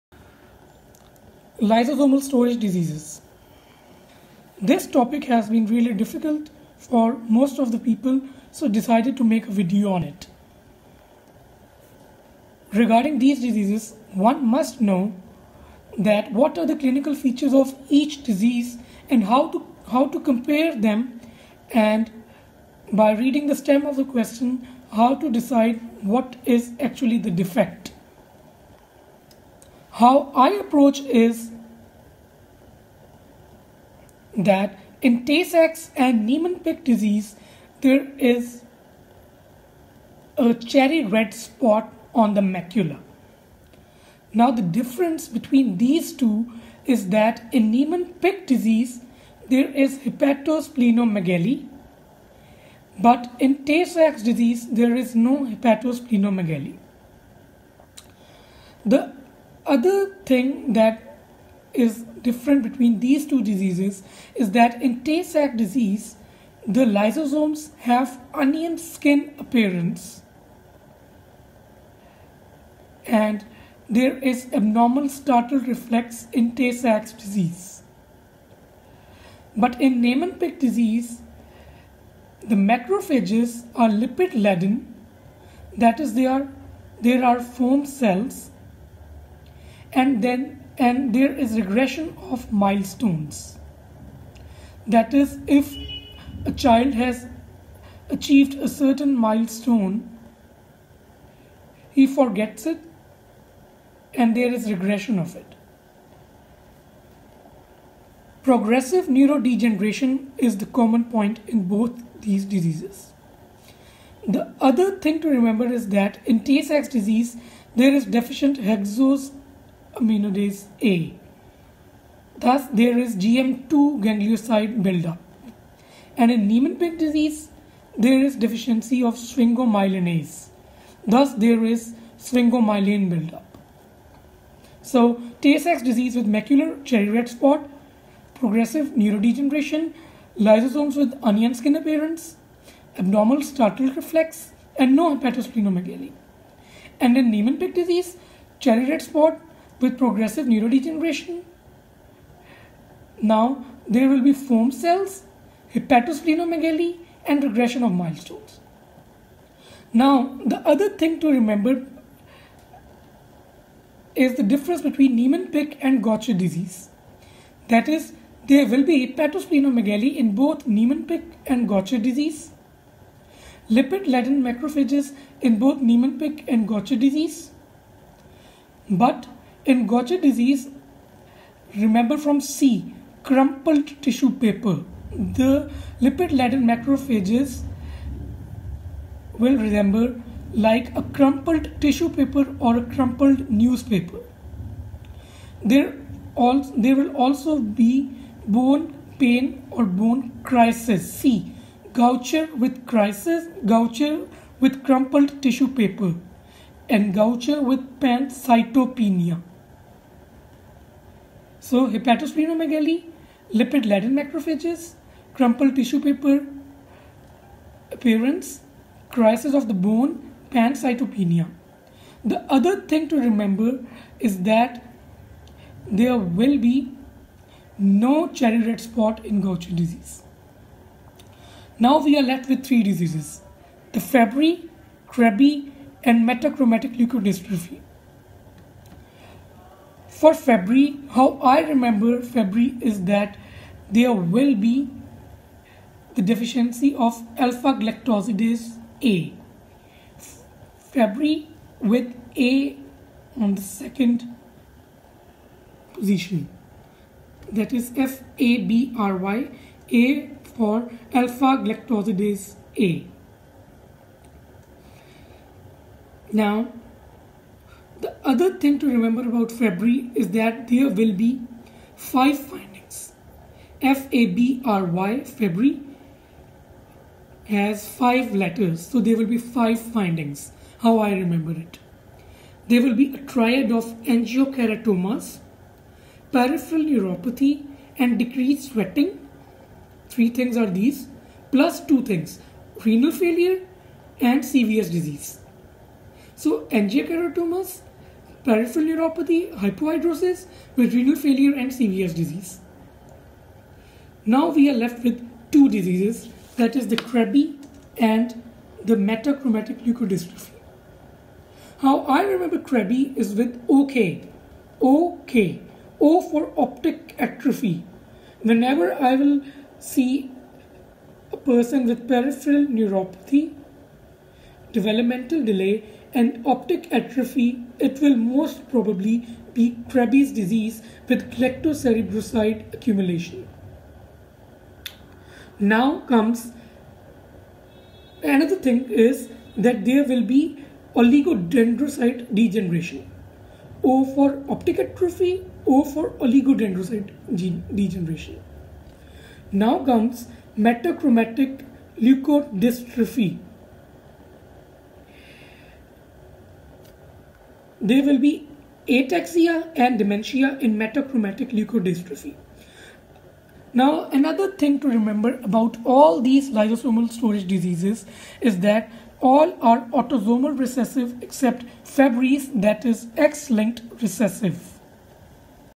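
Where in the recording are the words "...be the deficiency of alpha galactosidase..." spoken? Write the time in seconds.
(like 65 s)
244 s.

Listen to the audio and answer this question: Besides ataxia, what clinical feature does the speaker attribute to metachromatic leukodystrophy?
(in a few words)
Dementia.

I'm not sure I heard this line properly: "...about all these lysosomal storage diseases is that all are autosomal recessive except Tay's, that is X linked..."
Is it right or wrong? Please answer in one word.
wrong.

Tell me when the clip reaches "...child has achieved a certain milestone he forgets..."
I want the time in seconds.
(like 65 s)
96 s.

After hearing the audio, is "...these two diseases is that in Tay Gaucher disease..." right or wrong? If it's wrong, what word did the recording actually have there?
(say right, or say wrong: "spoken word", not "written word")
wrong: "Sachs", not "Gaucher".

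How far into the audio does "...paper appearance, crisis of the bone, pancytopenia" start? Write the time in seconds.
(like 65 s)
215 s.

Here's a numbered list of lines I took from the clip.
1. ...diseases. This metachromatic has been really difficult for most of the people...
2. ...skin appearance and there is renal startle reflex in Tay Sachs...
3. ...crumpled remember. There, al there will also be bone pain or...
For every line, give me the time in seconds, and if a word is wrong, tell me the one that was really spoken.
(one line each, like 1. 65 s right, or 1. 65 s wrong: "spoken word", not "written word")
1. 2 s wrong: "topic", not "metachromatic"
2. 68 s wrong: "abnormal", not "renal"
3. 192 s wrong: "newspaper", not "remember".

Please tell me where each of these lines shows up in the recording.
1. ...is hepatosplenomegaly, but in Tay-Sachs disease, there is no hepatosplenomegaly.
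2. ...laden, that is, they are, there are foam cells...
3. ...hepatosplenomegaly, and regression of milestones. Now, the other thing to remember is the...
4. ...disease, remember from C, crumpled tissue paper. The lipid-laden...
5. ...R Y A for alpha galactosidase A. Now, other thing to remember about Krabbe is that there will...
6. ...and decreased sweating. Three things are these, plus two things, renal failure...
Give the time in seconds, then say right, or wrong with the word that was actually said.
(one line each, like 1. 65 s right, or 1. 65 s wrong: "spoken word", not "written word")
1. 49 s right
2. 84 s right
3. 155 s right
4. 180 s right
5. 258 s wrong: "Fabry", not "Krabbe"
6. 287 s right.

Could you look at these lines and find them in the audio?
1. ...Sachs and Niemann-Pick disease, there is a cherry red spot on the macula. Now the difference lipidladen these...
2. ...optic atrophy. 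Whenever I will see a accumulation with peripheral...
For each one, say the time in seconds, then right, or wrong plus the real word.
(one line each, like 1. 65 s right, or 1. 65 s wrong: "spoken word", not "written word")
1. 35 s wrong: "between", not "lipidladen"
2. 316 s wrong: "person", not "accumulation".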